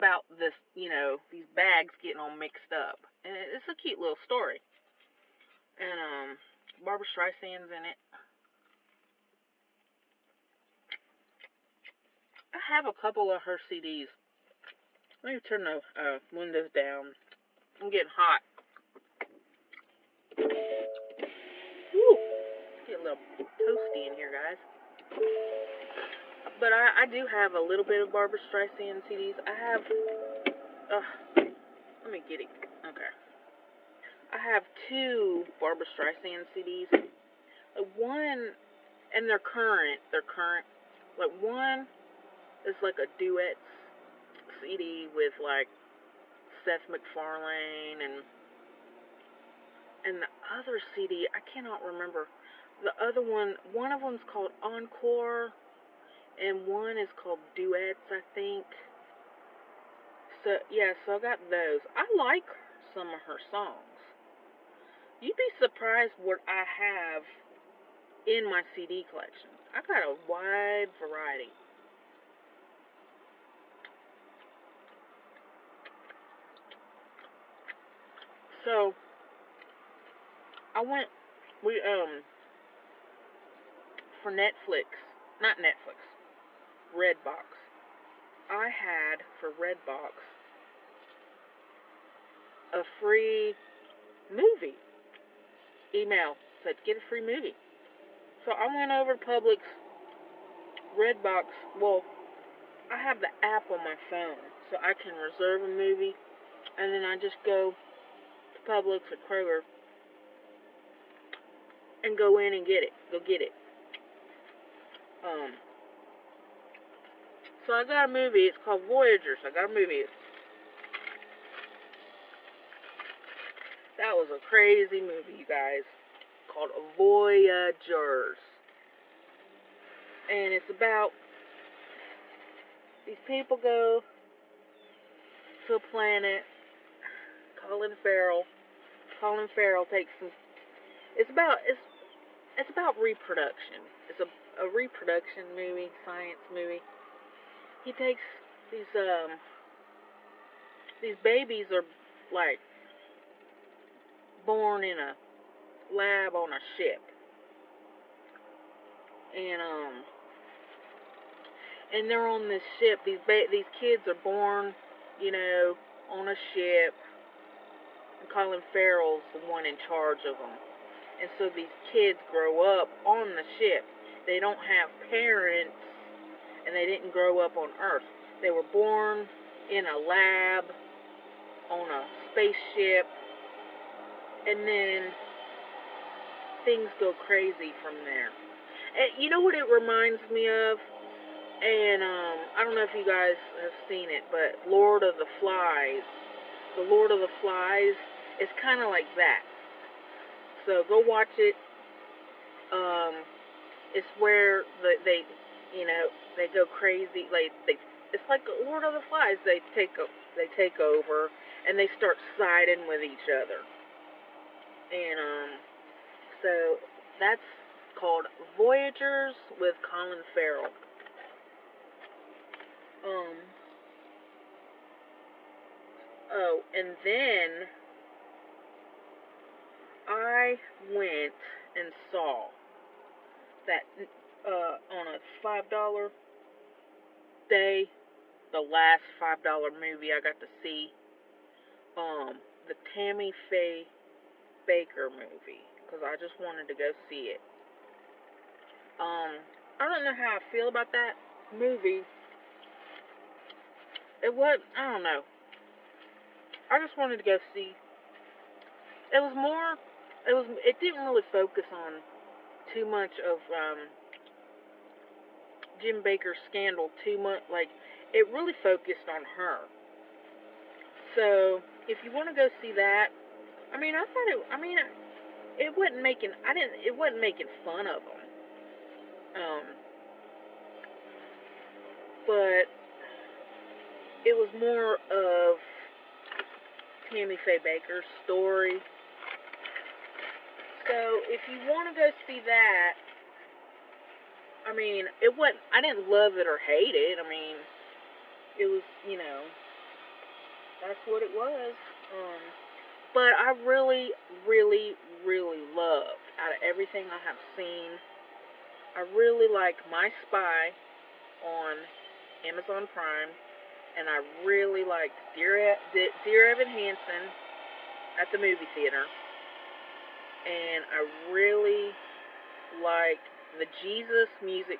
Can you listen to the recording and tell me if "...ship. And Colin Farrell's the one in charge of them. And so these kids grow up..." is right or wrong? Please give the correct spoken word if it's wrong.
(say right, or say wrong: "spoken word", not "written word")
right.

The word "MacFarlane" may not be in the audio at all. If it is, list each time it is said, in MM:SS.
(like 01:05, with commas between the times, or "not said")
00:46.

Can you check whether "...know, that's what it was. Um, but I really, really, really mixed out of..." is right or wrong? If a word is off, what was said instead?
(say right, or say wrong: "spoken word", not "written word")
wrong: "loved", not "mixed".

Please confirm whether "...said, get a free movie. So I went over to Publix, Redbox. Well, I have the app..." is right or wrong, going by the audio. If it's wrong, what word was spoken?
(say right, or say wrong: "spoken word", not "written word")
right.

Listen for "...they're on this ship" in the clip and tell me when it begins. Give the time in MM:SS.
02:42.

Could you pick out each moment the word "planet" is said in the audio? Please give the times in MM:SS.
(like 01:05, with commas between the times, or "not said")
02:15.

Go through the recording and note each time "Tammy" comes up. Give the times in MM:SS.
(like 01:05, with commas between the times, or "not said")
04:02, 04:47.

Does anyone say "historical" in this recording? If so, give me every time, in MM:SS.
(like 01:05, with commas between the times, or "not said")
not said.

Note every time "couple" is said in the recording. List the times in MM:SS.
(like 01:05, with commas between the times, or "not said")
00:12.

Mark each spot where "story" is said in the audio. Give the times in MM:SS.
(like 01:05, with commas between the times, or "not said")
00:04, 04:48.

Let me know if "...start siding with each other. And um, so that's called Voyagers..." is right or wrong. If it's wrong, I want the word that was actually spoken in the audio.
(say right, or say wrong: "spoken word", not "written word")
right.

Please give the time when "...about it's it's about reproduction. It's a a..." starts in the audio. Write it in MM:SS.
02:21.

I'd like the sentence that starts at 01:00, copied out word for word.
So, yeah, so I got those.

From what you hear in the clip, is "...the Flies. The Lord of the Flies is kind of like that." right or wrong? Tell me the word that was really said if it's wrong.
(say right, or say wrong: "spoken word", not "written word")
right.